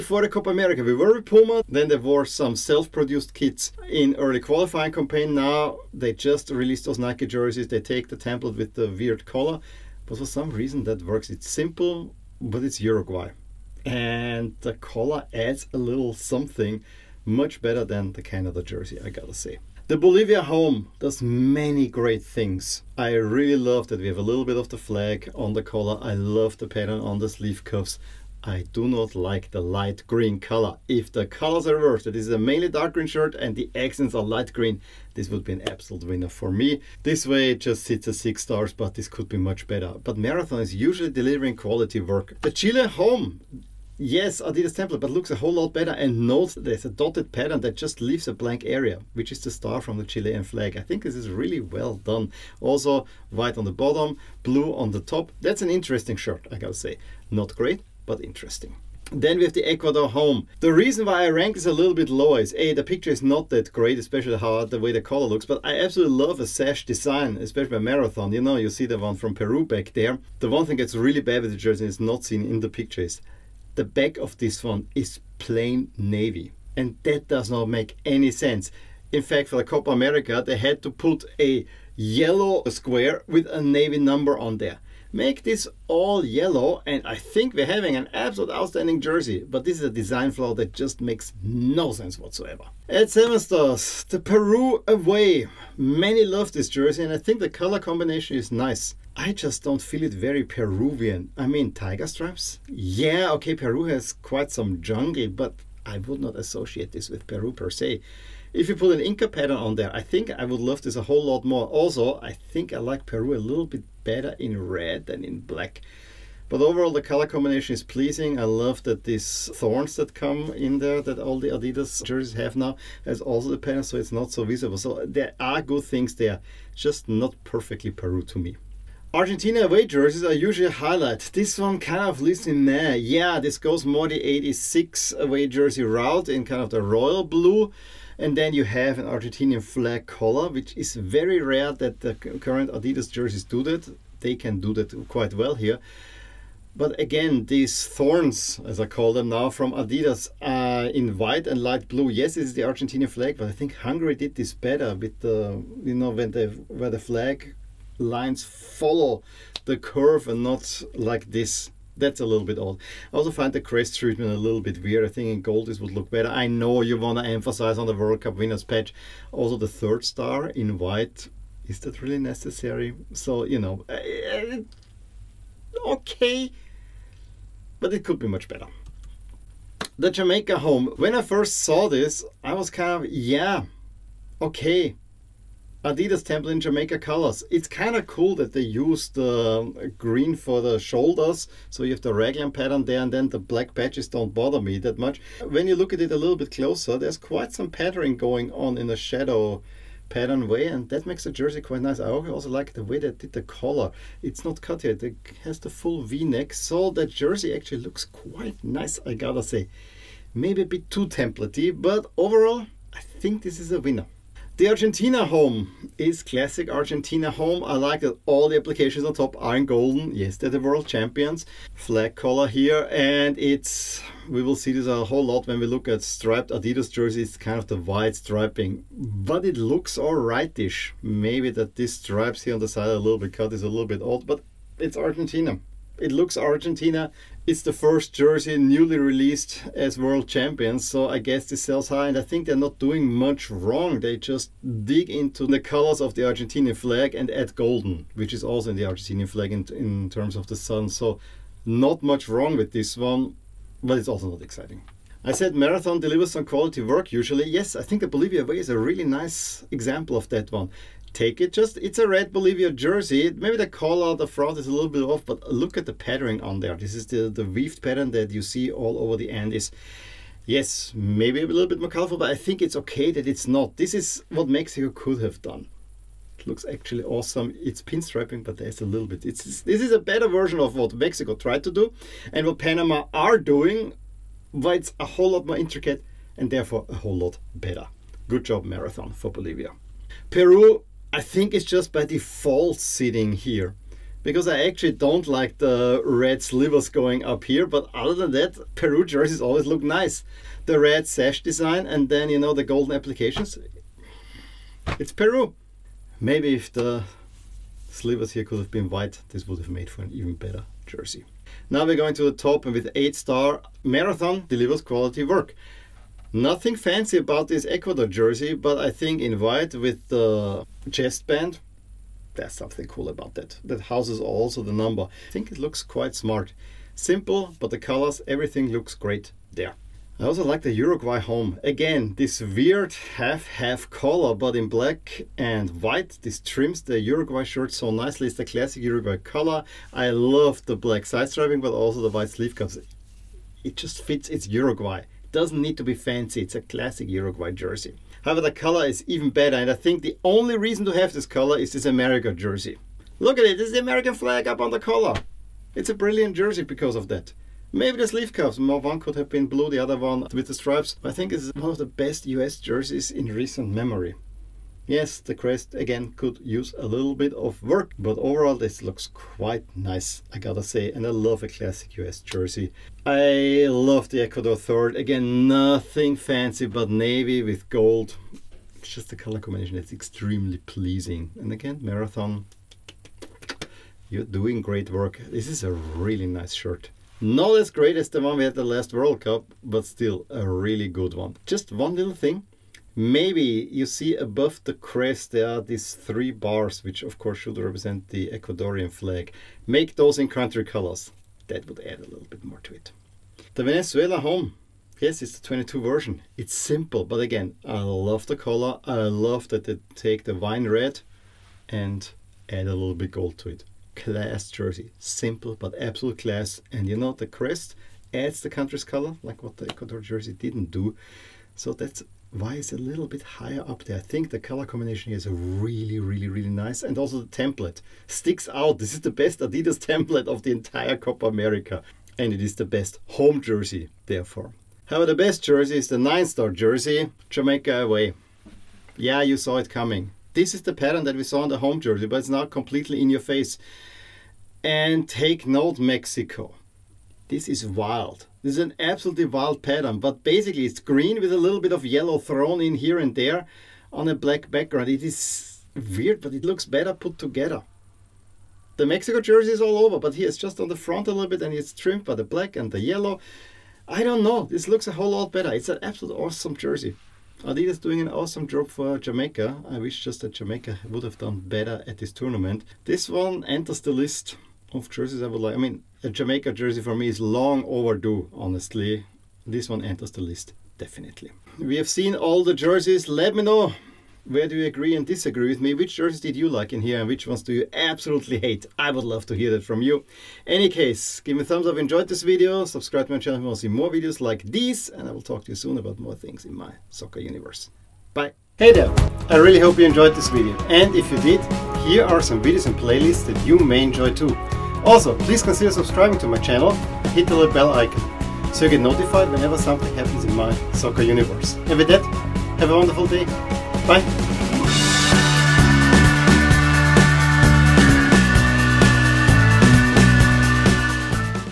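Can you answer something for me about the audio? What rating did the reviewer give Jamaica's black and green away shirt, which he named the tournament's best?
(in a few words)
9.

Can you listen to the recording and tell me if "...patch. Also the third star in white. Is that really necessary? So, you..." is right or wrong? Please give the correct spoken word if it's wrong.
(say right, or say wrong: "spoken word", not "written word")
right.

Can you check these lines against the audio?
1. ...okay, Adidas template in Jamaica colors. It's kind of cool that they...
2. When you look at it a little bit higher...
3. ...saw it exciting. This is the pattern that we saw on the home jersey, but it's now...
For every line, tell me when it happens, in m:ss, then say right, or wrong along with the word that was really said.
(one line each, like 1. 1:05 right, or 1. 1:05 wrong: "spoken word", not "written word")
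1. 3:04 right
2. 3:15 wrong: "closer", not "higher"
3. 7:19 wrong: "coming", not "exciting".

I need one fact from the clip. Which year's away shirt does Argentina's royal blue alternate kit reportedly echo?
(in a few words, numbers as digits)
1986.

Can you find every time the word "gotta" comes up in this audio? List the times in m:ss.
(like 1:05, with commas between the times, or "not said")
0:19, 0:56, 3:29, 6:10.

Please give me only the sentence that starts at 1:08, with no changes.
You know, you see the one from Peru back there.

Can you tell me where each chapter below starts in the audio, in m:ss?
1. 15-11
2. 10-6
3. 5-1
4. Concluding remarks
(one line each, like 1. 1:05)
1. 0:19
2. 2:58
3. 5:29
4. 8:00.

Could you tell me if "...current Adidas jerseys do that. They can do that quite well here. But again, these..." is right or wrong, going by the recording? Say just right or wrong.
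right.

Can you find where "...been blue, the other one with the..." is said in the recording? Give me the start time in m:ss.
5:59.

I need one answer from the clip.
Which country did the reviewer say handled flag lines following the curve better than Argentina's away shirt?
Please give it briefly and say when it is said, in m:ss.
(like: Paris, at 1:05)
Hungary, at 2:33.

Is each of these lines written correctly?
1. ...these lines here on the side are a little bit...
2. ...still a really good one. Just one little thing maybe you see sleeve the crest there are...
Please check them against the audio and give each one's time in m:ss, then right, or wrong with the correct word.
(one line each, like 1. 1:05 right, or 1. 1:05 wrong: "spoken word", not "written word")
1. 3:51 wrong: "stripes", not "lines"
2. 6:29 wrong: "above", not "sleeve".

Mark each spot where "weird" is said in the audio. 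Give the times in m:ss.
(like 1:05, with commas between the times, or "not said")
0:08, 2:44, 5:32, 7:35.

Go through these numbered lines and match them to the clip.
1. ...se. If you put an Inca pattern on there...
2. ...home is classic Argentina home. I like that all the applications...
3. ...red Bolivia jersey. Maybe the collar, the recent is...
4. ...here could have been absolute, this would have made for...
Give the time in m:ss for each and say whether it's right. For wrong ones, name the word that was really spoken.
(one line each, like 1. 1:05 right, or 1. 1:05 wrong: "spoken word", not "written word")
1. 1:47 right
2. 3:35 right
3. 4:22 wrong: "front", not "recent"
4. 5:08 wrong: "white", not "absolute".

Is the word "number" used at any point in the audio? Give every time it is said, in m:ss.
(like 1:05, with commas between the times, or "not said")
1:23, 5:24.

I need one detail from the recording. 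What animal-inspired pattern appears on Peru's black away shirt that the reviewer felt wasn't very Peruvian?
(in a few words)
tiger stripes.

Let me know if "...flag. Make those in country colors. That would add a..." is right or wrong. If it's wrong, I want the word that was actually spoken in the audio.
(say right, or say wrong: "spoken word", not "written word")
right.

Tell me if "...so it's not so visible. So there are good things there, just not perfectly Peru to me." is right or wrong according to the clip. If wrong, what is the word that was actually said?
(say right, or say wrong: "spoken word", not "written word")
right.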